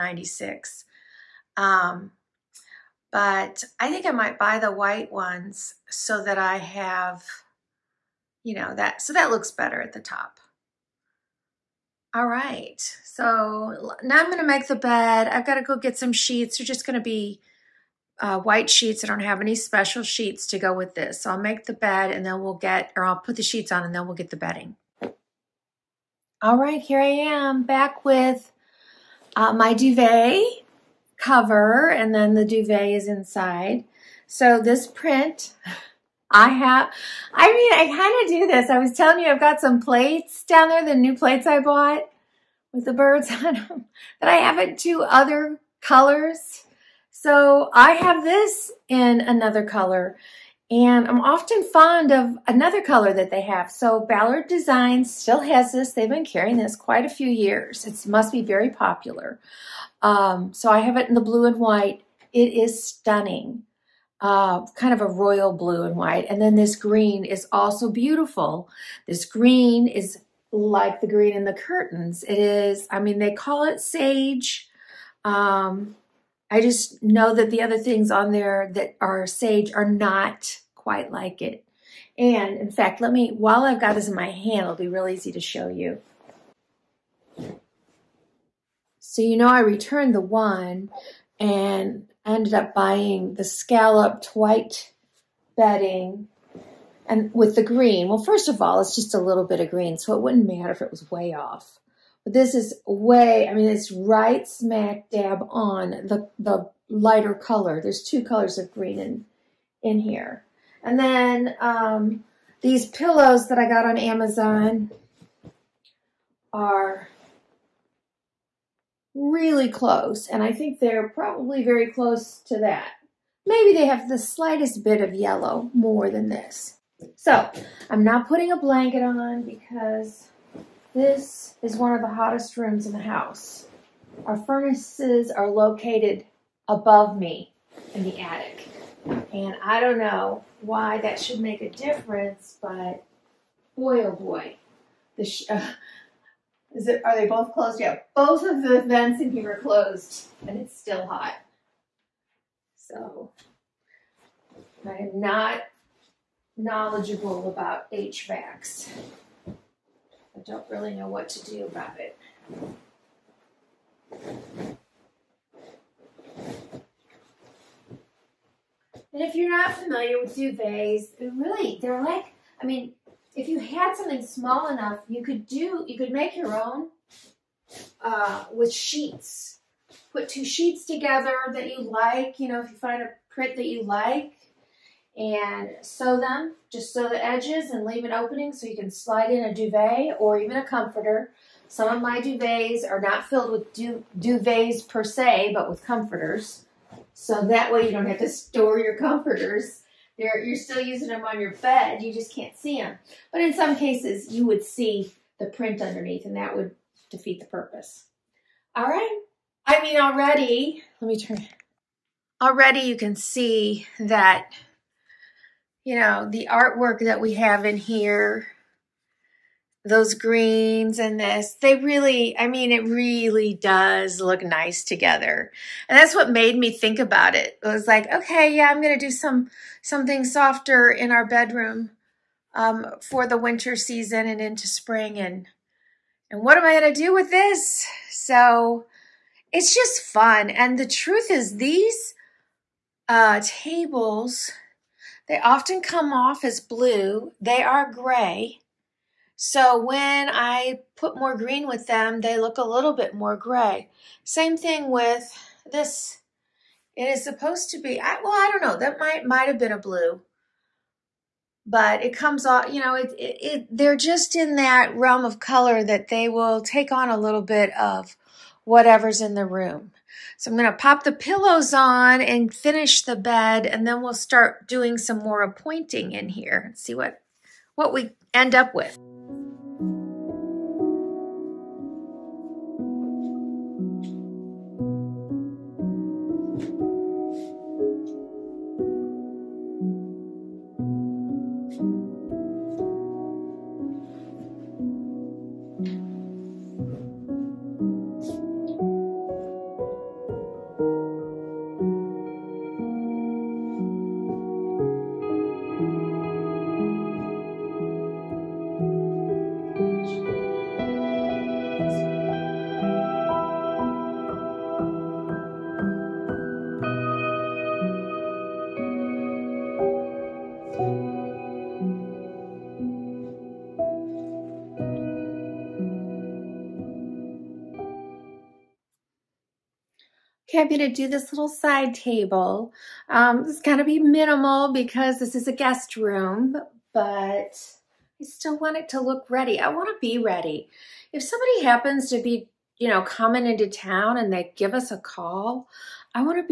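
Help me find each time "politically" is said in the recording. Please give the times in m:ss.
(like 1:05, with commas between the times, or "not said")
not said.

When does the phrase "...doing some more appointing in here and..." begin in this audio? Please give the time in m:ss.
4:34.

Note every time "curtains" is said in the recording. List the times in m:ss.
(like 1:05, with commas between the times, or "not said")
1:11.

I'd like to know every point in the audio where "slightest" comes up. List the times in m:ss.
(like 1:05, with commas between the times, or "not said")
2:04.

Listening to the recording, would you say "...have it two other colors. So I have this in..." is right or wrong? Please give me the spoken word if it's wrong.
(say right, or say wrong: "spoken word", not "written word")
right.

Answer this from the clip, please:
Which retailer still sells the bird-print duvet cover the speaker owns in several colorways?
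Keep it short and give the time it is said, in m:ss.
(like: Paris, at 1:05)
Ballard Designs, at 0:53.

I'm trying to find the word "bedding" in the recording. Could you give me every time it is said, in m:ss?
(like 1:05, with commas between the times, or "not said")
0:24, 1:35.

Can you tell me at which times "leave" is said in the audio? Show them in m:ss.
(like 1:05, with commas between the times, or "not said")
3:07.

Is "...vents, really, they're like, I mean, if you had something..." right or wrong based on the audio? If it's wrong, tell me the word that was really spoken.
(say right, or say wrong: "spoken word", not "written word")
wrong: "duvets", not "vents".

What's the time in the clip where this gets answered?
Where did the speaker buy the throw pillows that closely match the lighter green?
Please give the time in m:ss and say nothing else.
1:53.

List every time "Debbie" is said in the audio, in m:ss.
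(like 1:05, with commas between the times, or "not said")
not said.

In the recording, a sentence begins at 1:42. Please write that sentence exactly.
But this is way, I mean, it's right smack dab on the, the lighter color.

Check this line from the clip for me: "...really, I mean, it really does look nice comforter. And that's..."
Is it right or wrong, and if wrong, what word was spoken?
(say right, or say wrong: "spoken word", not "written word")
wrong: "together", not "comforter".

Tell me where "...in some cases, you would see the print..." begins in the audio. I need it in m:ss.
3:23.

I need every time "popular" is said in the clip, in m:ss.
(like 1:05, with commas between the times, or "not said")
0:58.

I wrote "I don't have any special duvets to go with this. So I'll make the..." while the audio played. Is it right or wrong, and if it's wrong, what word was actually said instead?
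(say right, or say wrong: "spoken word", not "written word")
wrong: "sheets", not "duvets".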